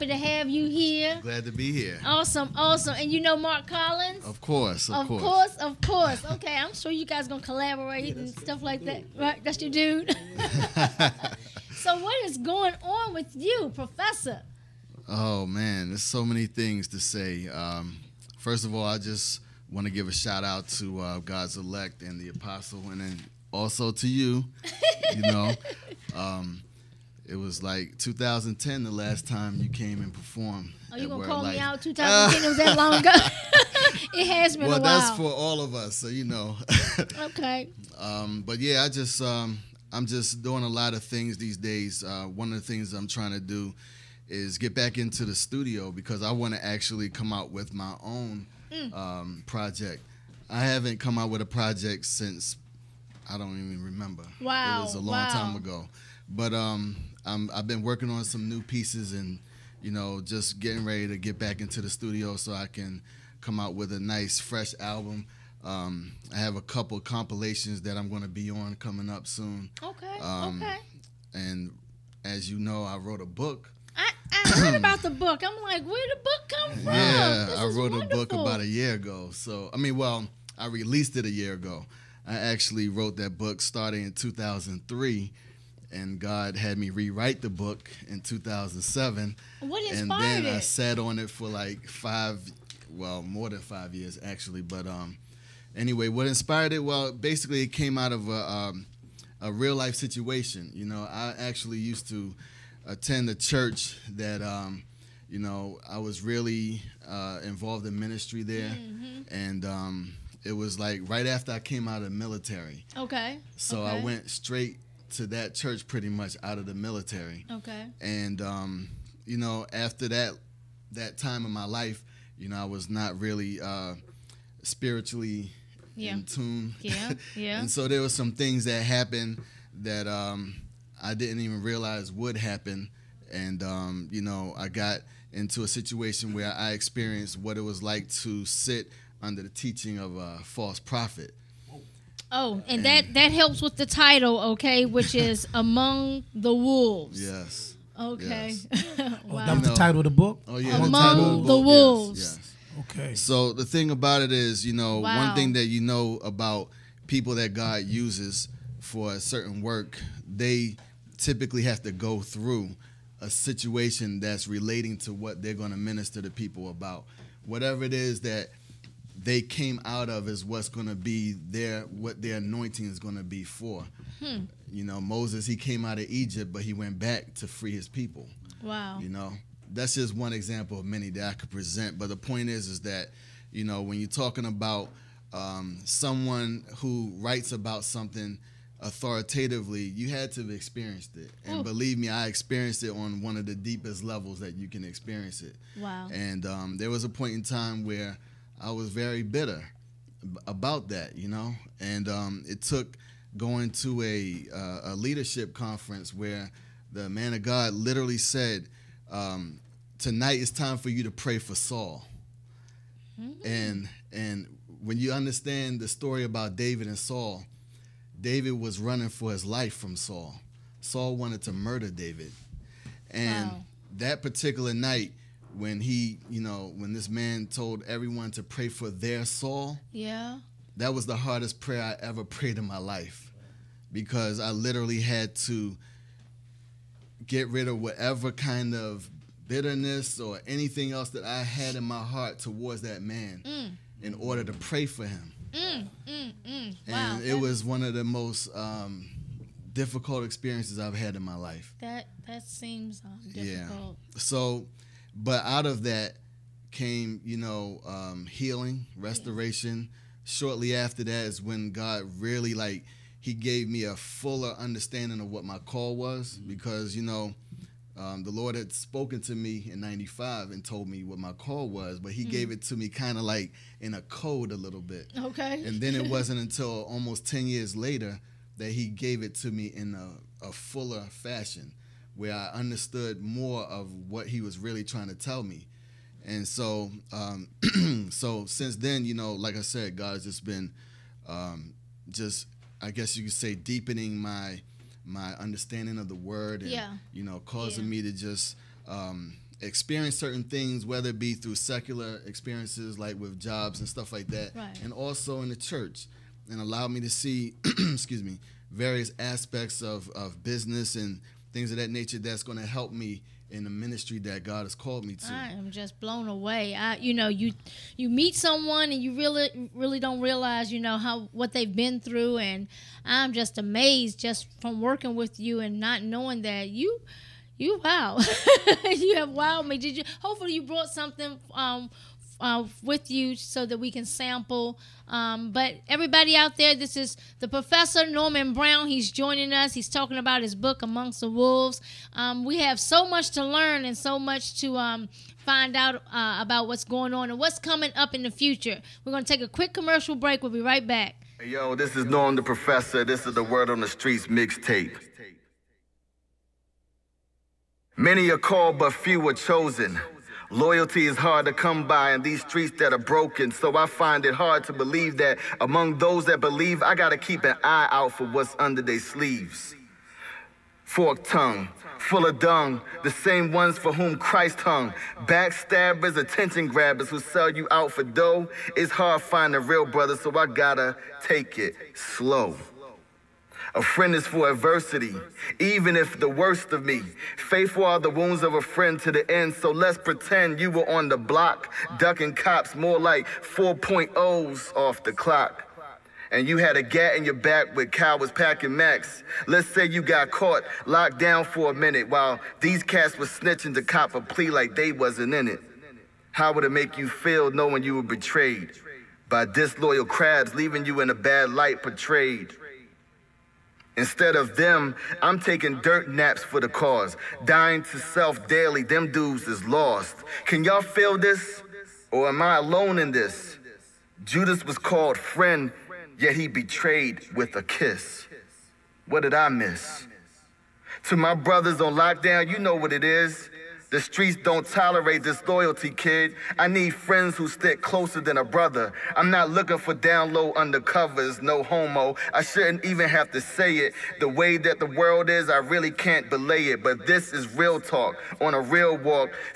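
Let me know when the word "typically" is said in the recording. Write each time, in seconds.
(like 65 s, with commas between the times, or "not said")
161 s.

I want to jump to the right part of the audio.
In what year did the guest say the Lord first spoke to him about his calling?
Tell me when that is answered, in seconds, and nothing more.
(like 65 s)
269 s.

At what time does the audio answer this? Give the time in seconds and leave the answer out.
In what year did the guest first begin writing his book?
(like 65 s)
84 s.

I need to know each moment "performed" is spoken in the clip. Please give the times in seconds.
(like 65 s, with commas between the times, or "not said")
30 s.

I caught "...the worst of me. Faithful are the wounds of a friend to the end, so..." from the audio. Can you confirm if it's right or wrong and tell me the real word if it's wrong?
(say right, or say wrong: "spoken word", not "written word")
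right.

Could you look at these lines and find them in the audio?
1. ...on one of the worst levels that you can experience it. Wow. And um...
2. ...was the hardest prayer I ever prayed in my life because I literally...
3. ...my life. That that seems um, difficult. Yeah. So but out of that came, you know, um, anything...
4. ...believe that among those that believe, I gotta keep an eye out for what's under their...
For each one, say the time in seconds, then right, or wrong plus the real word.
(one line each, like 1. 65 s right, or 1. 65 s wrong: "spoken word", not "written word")
1. 192 s wrong: "deepest", not "worst"
2. 230 s right
3. 251 s wrong: "healing", not "anything"
4. 364 s right.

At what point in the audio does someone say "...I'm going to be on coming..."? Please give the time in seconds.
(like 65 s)
67 s.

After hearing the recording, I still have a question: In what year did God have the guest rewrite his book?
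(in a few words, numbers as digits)
2007.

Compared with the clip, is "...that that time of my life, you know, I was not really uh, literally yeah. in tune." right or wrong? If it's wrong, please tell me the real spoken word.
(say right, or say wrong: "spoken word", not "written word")
wrong: "spiritually", not "literally".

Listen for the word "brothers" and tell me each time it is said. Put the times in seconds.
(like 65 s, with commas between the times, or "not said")
379 s, 431 s, 438 s.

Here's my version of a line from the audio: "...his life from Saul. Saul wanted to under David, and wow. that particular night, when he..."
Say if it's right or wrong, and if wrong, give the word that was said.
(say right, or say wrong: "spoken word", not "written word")
wrong: "murder", not "under".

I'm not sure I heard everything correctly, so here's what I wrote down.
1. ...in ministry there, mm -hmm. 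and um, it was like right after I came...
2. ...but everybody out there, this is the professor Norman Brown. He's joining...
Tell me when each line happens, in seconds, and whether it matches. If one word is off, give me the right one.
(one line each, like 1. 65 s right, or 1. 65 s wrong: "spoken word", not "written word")
1. 107 s right
2. 335 s right.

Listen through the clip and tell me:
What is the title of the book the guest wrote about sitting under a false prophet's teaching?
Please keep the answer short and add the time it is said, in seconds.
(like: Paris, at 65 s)
Among the Wolves, at 145 s.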